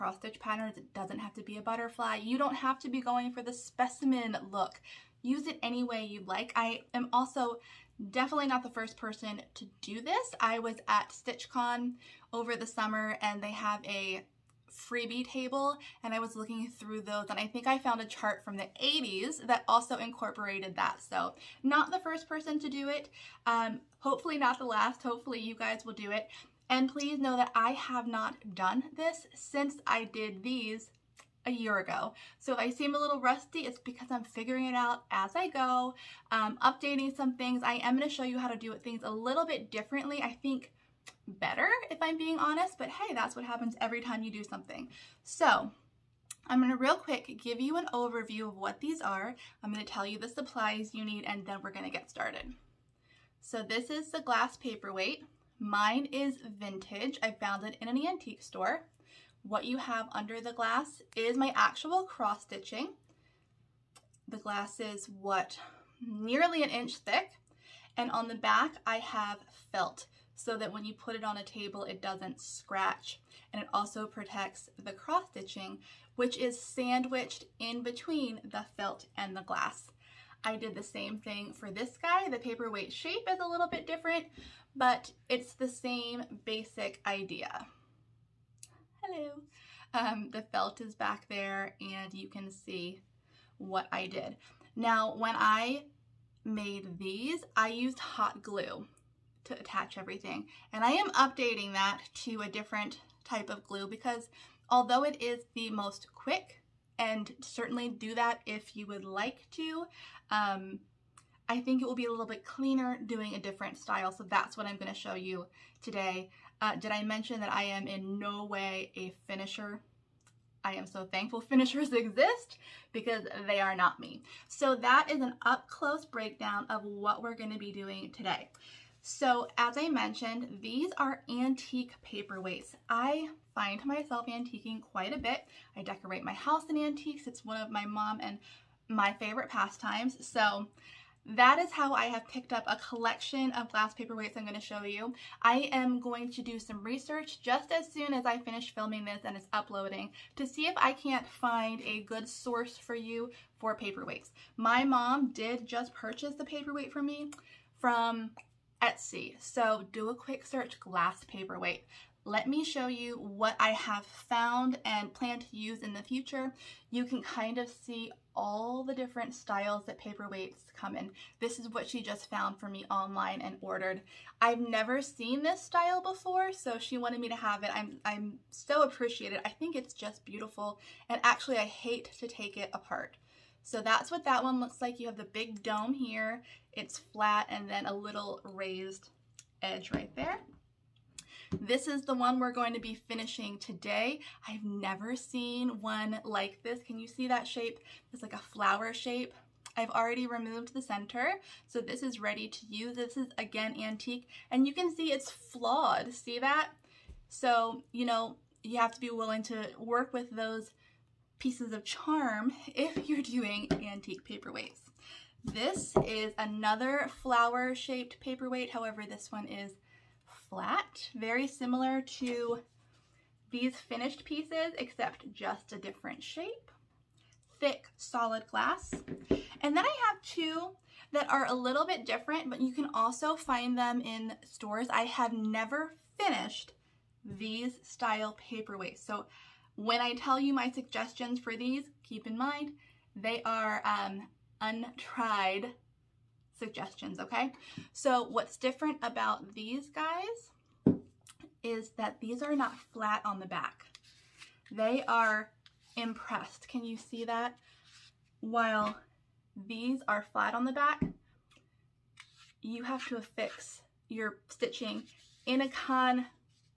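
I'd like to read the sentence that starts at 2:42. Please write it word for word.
Let me show you what I have found and plan to use in the future.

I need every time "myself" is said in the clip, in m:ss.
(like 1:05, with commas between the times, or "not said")
2:13.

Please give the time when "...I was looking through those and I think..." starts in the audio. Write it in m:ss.
0:16.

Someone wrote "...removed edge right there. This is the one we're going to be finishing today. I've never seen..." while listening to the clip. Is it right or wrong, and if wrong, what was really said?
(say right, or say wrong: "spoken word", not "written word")
wrong: "raised", not "removed".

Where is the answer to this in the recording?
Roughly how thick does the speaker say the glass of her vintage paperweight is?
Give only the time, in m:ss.
1:06.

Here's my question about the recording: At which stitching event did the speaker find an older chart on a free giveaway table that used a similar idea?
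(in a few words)
StitchCon.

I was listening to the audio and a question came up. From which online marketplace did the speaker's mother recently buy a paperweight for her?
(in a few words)
Etsy.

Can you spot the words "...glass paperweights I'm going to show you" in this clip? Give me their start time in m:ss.
2:23.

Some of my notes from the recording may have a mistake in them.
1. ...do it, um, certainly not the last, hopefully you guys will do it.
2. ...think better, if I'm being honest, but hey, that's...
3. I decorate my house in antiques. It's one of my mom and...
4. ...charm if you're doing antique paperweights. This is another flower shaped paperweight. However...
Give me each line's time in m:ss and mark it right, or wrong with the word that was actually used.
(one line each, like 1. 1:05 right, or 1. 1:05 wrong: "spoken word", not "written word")
1. 0:22 wrong: "hopefully", not "certainly"
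2. 0:40 right
3. 2:15 right
4. 3:31 right.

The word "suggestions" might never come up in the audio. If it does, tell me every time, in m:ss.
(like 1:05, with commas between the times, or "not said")
4:00, 4:06.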